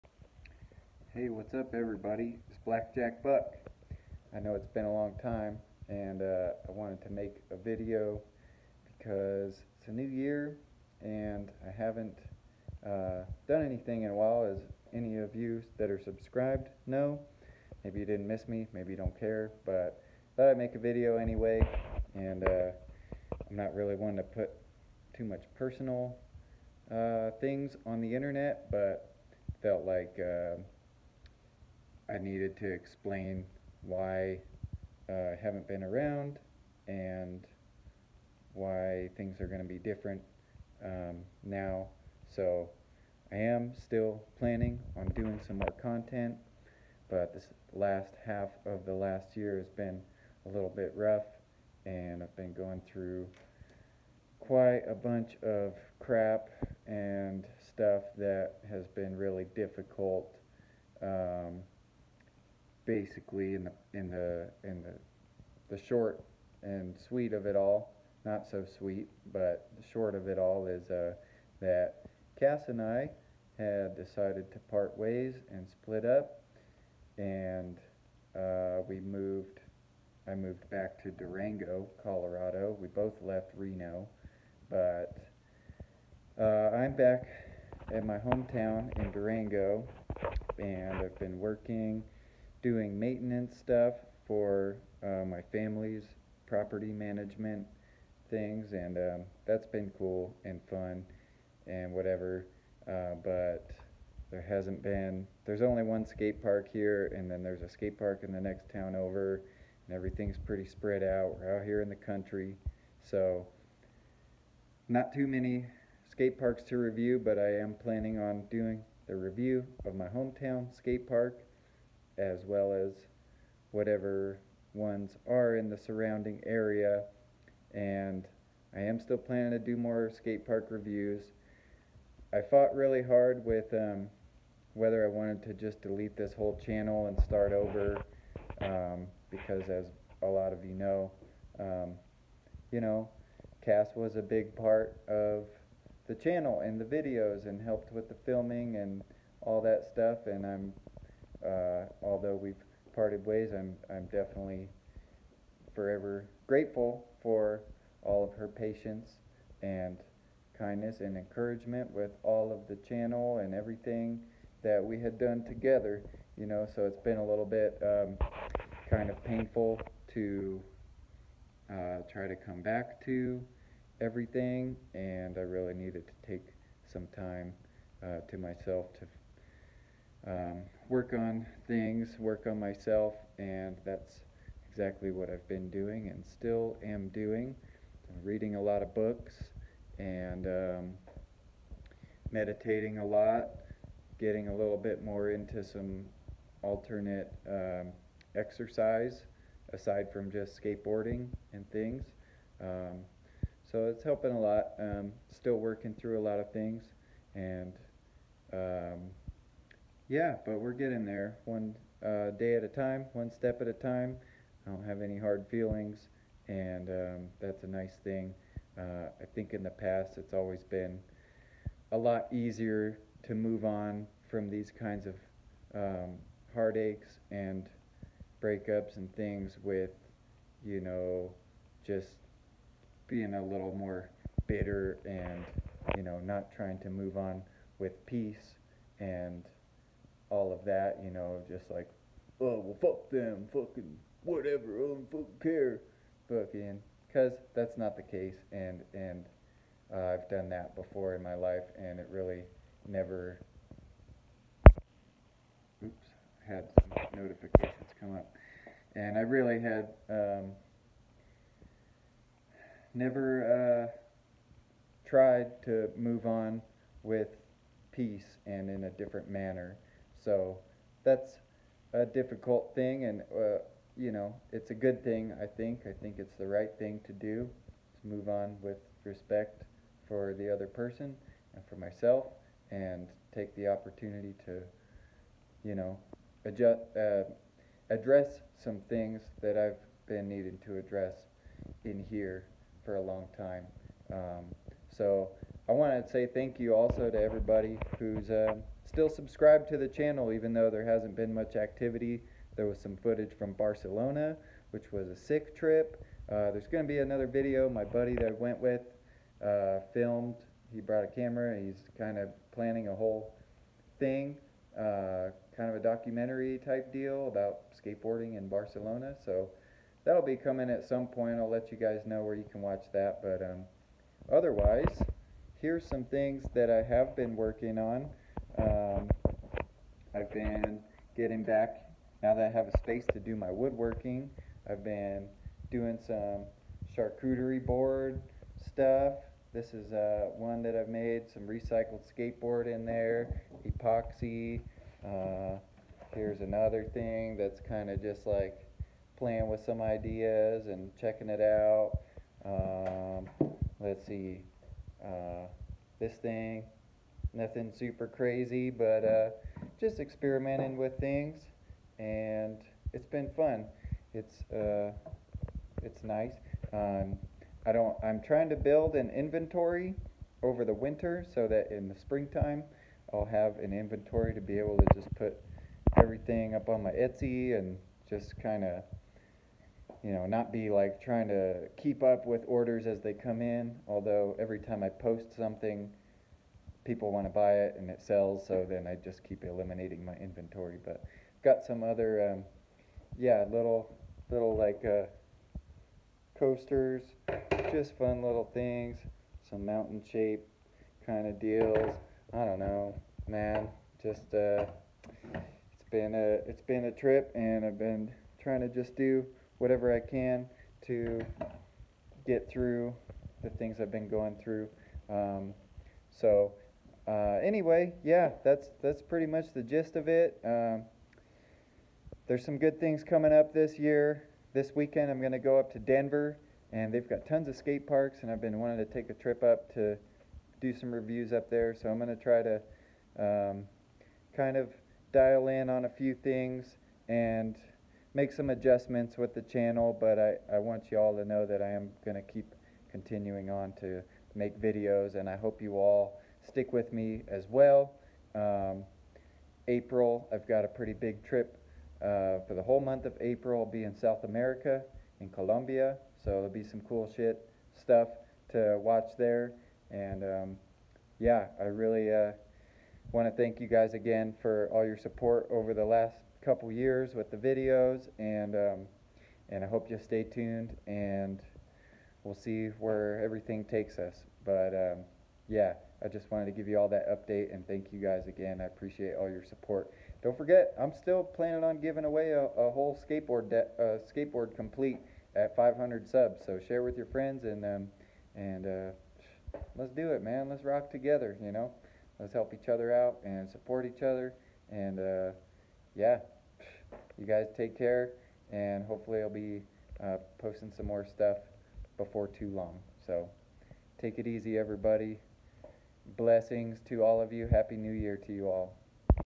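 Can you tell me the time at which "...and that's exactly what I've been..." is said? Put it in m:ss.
3:03.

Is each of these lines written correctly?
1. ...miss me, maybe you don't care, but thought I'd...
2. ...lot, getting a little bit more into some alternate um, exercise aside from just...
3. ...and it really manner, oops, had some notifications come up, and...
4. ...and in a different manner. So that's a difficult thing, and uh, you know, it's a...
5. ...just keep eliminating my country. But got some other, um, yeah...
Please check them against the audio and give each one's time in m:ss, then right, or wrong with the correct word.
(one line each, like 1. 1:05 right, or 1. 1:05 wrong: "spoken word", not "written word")
1. 0:18 right
2. 3:13 right
3. 4:11 wrong: "never", not "manner"
4. 4:28 right
5. 6:29 wrong: "inventory", not "country".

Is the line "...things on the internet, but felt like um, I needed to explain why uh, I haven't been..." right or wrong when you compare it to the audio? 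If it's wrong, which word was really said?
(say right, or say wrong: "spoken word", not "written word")
right.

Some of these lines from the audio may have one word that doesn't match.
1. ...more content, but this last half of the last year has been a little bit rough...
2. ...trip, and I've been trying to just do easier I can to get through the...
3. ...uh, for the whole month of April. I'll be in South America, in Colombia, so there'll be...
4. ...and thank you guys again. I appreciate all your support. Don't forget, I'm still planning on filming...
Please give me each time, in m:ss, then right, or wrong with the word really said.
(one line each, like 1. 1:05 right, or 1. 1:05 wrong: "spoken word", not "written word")
1. 0:45 right
2. 6:46 wrong: "whatever", not "easier"
3. 7:32 right
4. 7:57 wrong: "giving", not "filming".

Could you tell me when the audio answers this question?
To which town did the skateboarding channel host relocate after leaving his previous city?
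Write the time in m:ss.
1:21.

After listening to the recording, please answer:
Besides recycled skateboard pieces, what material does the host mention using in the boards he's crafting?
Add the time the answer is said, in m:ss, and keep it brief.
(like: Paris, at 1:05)
epoxy, at 5:43.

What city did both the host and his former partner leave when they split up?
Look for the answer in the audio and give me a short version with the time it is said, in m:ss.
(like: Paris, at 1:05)
Reno, at 1:23.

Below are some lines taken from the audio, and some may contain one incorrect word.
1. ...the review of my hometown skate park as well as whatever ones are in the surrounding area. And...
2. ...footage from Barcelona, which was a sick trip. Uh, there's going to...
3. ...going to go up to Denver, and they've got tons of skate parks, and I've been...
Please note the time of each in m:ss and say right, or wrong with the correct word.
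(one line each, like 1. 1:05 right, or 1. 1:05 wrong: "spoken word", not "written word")
1. 1:59 right
2. 5:02 right
3. 7:05 right.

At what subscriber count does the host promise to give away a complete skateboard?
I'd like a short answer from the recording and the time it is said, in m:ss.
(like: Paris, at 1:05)
500, at 8:05.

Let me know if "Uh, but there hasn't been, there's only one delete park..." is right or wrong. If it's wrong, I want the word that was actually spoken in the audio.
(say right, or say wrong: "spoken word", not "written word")
wrong: "skate", not "delete".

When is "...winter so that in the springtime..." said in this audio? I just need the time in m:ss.
6:10.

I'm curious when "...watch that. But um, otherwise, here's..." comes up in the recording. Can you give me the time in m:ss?
5:22.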